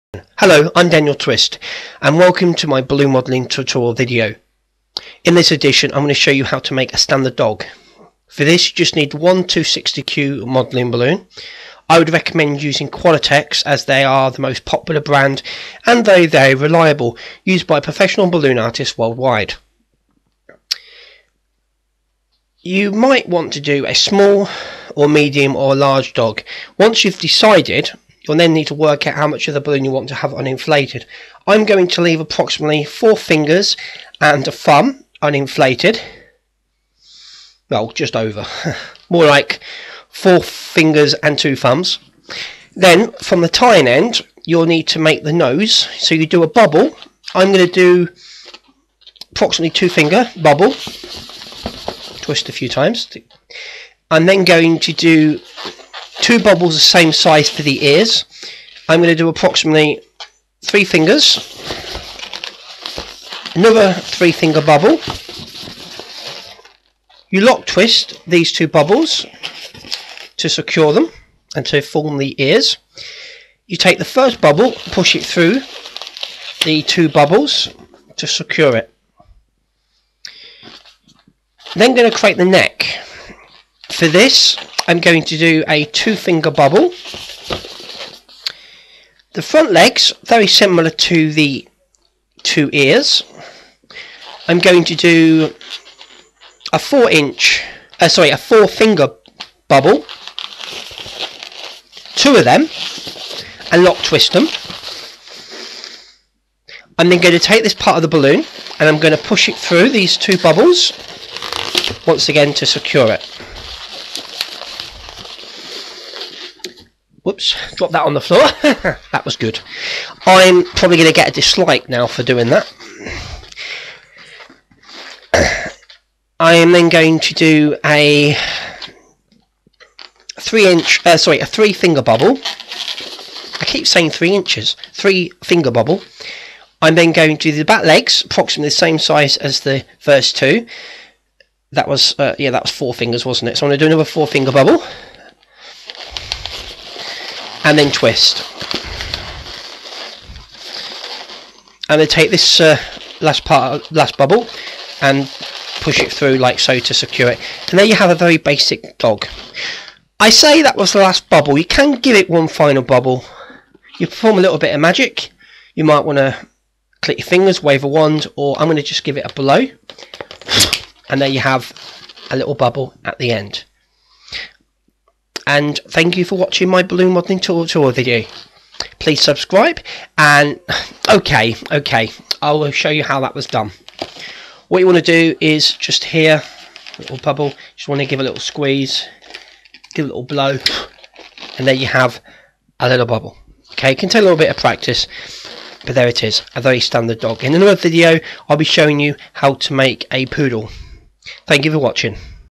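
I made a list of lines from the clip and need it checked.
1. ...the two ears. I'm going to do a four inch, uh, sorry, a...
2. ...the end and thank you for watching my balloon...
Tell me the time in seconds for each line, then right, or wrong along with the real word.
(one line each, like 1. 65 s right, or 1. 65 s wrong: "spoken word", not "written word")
1. 91 s right
2. 173 s right.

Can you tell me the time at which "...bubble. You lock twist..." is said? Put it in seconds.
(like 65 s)
64 s.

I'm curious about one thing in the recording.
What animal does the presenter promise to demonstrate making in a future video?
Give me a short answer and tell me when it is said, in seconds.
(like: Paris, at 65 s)
Poodle, at 200 s.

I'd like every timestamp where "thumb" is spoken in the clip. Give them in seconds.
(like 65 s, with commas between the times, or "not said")
34 s, 41 s.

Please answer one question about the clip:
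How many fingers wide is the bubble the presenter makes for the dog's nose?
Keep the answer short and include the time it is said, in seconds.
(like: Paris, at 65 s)
2 fingers, at 49 s.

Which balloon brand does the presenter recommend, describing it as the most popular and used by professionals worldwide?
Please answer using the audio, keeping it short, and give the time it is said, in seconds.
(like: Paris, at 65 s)
Qualitex, at 12 s.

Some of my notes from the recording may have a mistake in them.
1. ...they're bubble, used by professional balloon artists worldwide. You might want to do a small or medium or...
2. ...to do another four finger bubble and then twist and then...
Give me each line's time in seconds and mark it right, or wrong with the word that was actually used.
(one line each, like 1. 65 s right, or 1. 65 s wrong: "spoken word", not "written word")
1. 16 s wrong: "reliable", not "bubble"
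2. 143 s right.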